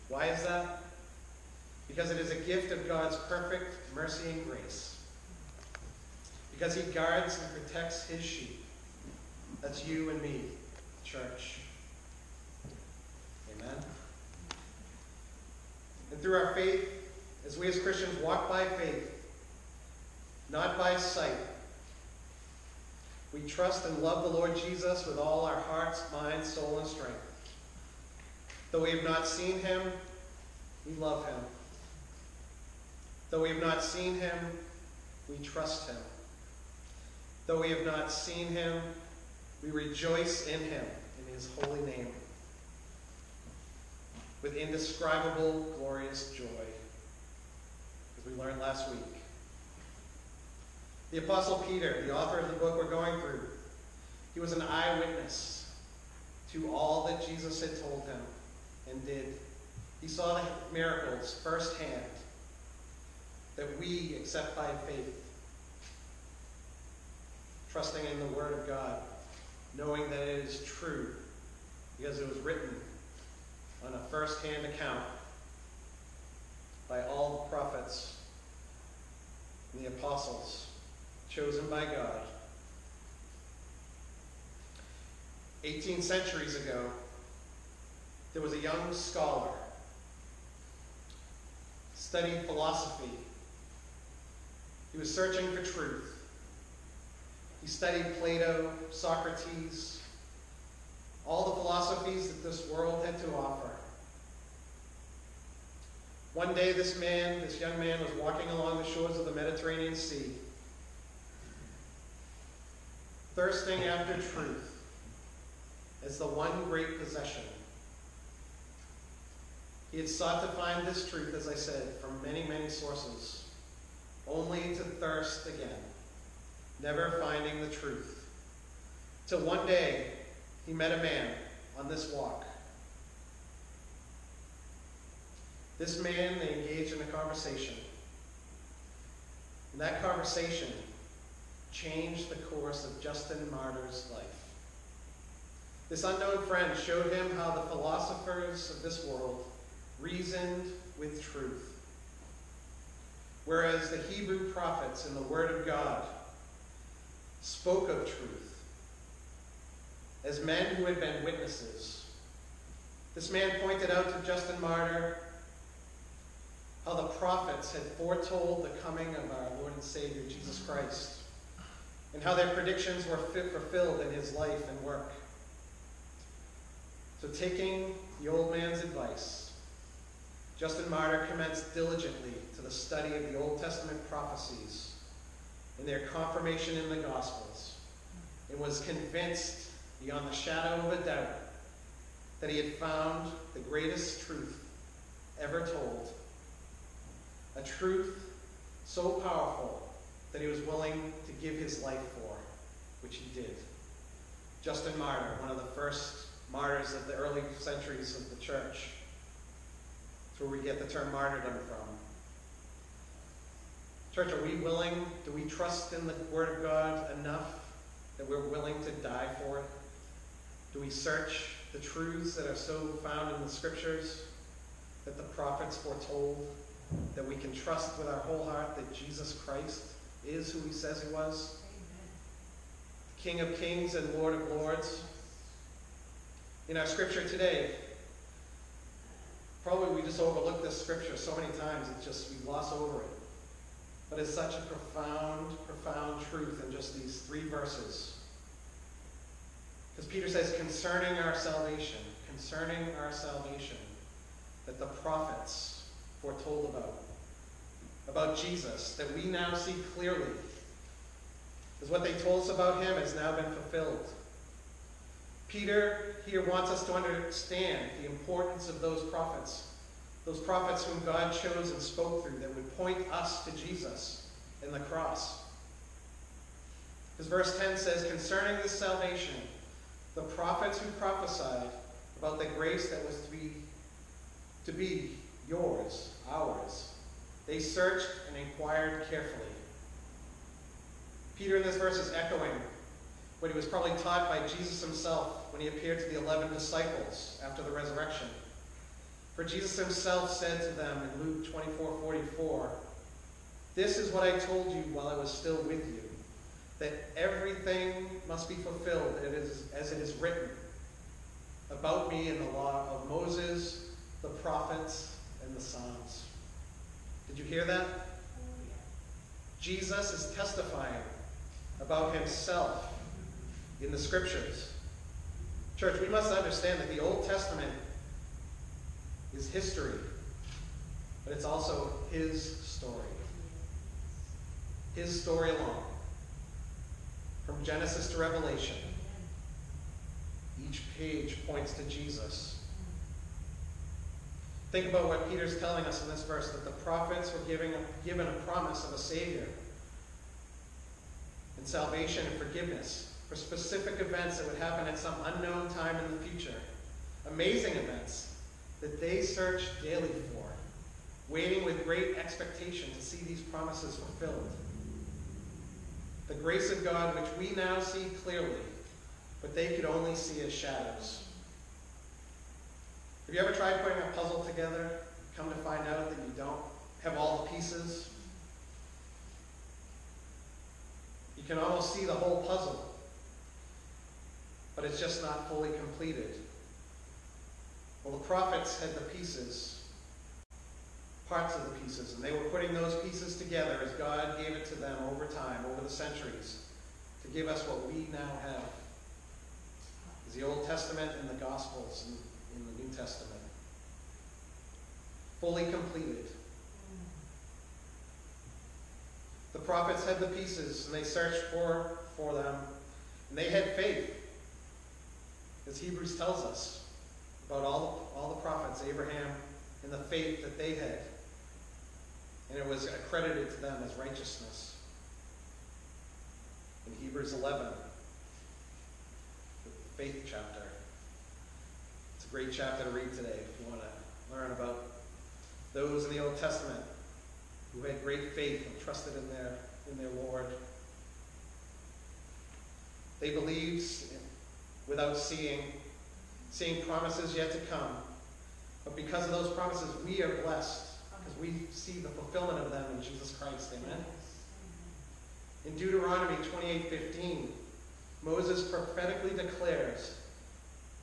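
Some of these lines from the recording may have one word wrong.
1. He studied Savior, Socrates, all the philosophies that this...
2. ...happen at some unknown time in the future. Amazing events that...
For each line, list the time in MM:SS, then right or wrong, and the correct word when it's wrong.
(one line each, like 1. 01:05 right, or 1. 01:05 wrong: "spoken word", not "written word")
1. 01:37 wrong: "Plato", not "Savior"
2. 05:54 right.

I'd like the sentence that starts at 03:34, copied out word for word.
Church, are we willing, do we trust in the Word of God enough that we're willing to die for it?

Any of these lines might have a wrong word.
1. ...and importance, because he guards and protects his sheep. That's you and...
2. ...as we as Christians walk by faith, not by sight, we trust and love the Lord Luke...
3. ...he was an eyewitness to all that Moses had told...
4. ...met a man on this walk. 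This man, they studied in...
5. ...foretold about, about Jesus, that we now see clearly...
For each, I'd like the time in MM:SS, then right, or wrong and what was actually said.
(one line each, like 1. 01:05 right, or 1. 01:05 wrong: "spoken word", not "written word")
1. 00:04 wrong: "grace", not "importance"
2. 00:17 wrong: "Jesus", not "Luke"
3. 00:54 wrong: "Jesus", not "Moses"
4. 02:10 wrong: "engaged", not "studied"
5. 04:16 right.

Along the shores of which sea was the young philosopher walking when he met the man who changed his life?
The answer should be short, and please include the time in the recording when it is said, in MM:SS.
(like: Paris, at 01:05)
Mediterranean Sea, at 01:49.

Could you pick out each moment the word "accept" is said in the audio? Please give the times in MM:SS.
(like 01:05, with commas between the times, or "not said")
01:04.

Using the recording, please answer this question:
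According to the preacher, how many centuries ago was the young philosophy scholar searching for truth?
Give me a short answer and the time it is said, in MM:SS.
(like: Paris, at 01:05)
18, at 01:25.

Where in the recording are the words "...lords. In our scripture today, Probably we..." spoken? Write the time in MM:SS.
03:54.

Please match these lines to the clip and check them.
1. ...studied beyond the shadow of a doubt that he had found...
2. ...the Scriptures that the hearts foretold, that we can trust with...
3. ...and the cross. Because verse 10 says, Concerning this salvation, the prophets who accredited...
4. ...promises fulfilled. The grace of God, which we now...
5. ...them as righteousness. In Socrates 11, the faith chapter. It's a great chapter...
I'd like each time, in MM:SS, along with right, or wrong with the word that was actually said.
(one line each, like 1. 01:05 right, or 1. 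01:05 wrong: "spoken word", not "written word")
1. 03:08 wrong: "convinced", not "studied"
2. 03:43 wrong: "prophets", not "hearts"
3. 04:34 wrong: "prophesied", not "accredited"
4. 06:03 right
5. 07:03 wrong: "Hebrews", not "Socrates".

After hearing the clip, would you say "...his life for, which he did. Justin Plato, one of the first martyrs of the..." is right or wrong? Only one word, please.
wrong.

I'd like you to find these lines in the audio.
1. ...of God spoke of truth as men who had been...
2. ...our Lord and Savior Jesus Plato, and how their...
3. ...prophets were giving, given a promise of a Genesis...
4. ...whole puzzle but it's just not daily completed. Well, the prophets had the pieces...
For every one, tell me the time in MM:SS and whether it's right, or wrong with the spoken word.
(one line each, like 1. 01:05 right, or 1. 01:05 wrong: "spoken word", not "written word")
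1. 02:35 right
2. 02:49 wrong: "Christ", not "Plato"
3. 05:46 wrong: "Savior", not "Genesis"
4. 06:22 wrong: "fully", not "daily".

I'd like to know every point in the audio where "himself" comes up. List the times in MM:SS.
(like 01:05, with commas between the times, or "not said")
04:54, 04:59, 05:22.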